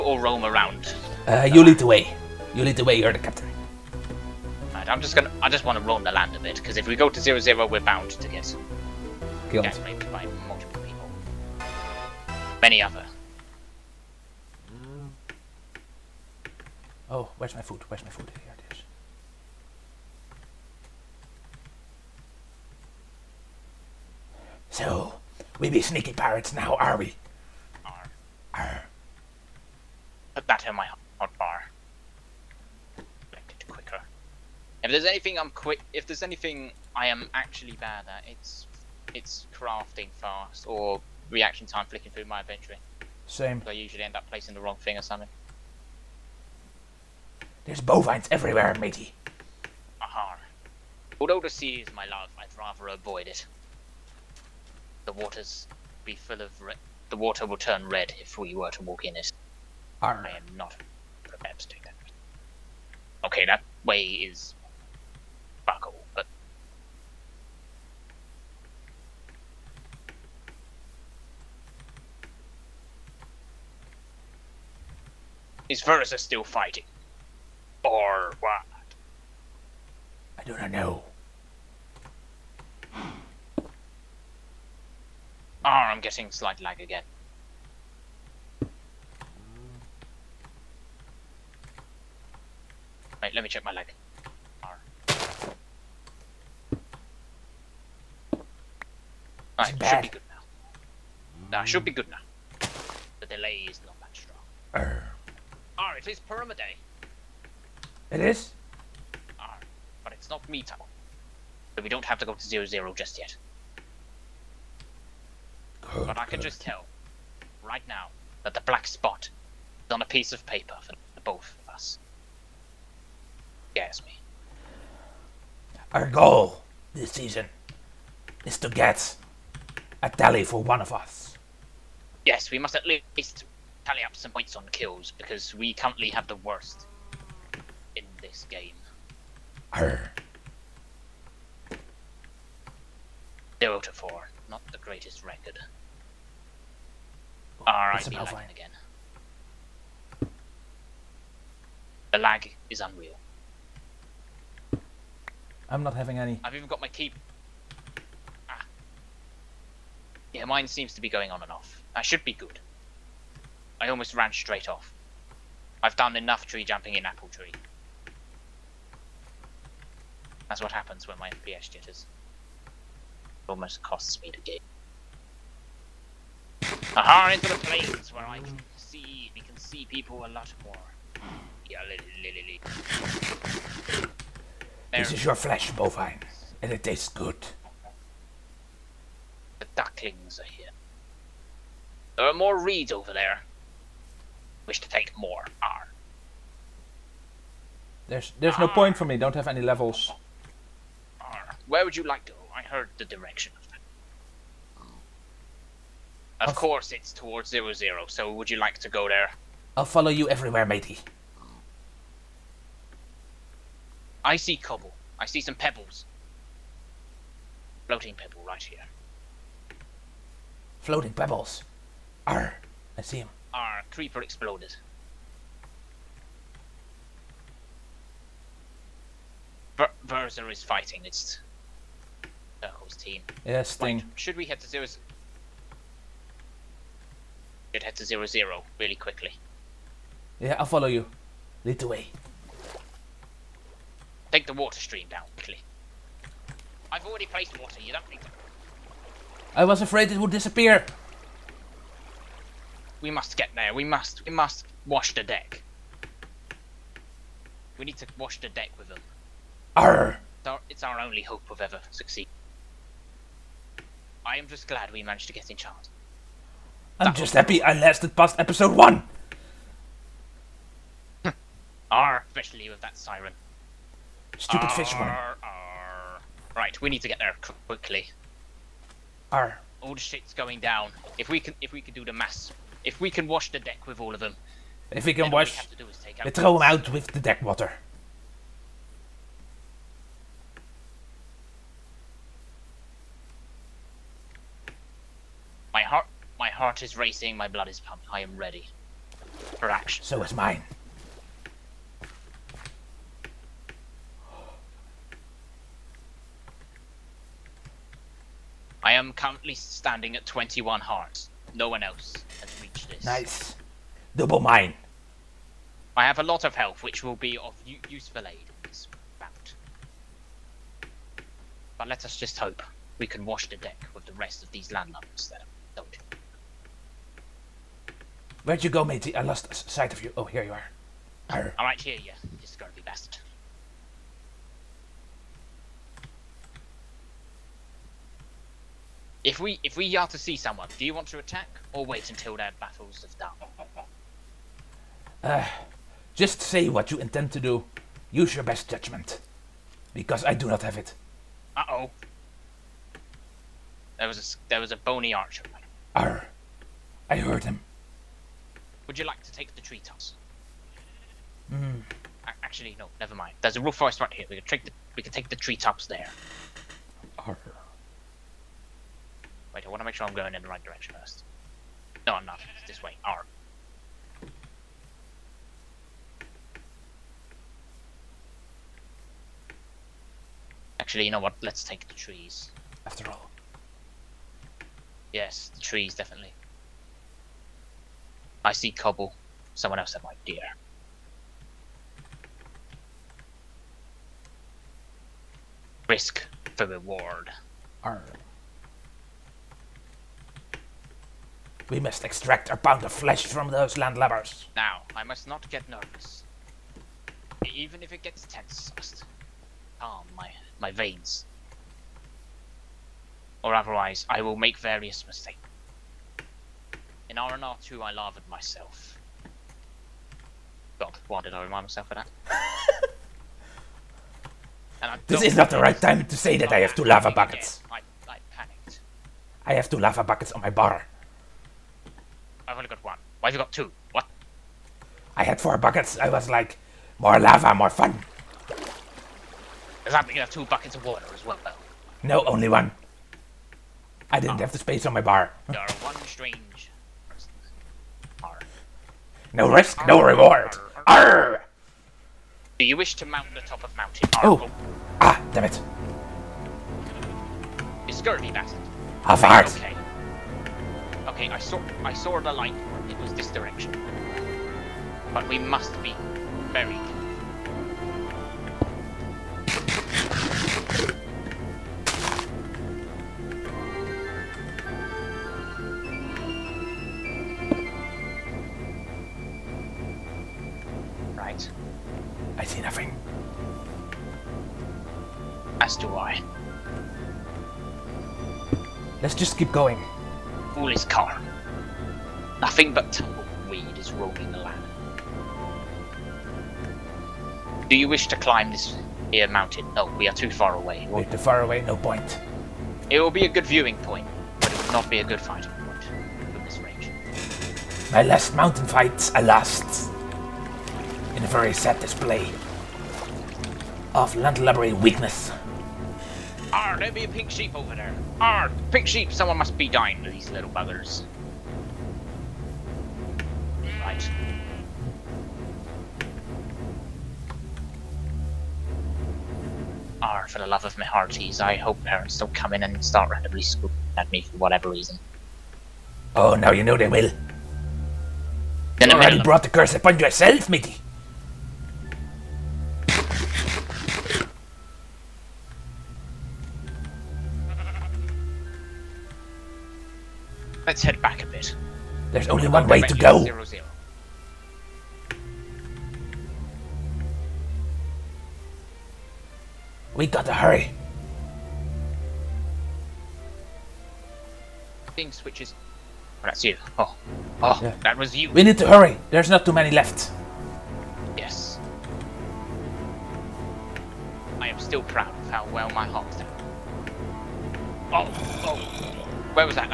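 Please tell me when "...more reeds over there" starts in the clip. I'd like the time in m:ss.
3:12.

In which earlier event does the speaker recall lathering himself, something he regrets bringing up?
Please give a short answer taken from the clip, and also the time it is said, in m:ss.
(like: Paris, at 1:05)
RNR2, at 6:57.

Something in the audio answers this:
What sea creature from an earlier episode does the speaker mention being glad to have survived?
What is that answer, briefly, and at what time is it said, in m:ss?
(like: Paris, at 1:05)
siren, at 4:32.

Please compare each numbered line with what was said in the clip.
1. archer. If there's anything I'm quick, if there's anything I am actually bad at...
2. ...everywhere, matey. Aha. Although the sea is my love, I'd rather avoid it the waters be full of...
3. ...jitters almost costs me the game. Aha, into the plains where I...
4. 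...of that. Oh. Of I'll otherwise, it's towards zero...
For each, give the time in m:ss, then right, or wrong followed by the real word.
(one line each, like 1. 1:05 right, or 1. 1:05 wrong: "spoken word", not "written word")
1. 0:33 wrong: "quicker", not "archer"
2. 0:48 right
3. 2:51 right
4. 3:23 wrong: "course", not "otherwise".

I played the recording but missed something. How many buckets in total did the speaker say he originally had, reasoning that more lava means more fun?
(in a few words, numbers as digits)
4.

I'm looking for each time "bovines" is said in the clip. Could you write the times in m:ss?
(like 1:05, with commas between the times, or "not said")
0:47, 3:05.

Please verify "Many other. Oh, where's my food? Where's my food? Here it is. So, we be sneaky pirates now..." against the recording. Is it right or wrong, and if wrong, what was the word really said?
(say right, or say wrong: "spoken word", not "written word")
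right.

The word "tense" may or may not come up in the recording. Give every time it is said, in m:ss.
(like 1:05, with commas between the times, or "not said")
6:48.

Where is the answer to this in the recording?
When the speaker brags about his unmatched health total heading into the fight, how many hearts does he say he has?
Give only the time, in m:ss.
5:10.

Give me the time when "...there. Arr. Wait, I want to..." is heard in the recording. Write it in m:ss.
6:05.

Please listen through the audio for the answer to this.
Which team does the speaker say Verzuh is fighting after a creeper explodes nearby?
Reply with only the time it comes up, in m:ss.
3:52.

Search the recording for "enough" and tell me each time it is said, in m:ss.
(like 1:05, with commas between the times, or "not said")
2:46.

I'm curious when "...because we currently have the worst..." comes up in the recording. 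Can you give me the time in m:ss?
2:15.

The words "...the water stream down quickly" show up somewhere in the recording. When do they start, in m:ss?
4:04.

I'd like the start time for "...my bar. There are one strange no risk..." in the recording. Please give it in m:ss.
7:24.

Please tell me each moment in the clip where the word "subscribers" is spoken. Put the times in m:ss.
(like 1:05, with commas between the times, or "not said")
not said.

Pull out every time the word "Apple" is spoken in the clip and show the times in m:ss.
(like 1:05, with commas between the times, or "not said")
2:47.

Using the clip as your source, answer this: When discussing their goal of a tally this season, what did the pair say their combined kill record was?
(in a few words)
0 to 4.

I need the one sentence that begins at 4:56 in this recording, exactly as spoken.
heart is racing, my blood is pumping.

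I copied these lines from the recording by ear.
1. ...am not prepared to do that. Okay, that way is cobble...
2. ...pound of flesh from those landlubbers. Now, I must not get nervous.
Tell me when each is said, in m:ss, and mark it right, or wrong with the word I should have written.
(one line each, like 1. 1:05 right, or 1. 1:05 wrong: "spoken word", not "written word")
1. 1:00 wrong: "buckle", not "cobble"
2. 6:42 right.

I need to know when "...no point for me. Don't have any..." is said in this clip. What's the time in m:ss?
3:18.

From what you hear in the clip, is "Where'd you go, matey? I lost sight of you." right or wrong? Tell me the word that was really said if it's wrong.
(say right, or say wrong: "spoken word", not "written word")
right.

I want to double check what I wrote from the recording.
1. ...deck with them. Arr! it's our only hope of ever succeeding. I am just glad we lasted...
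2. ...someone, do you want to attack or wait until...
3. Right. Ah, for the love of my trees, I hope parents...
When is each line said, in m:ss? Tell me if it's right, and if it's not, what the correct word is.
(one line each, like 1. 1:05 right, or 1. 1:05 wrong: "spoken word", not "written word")
1. 4:18 wrong: "managed", not "lasted"
2. 5:40 right
3. 8:43 wrong: "hearties", not "trees".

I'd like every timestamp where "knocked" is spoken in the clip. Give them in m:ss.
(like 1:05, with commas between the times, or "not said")
not said.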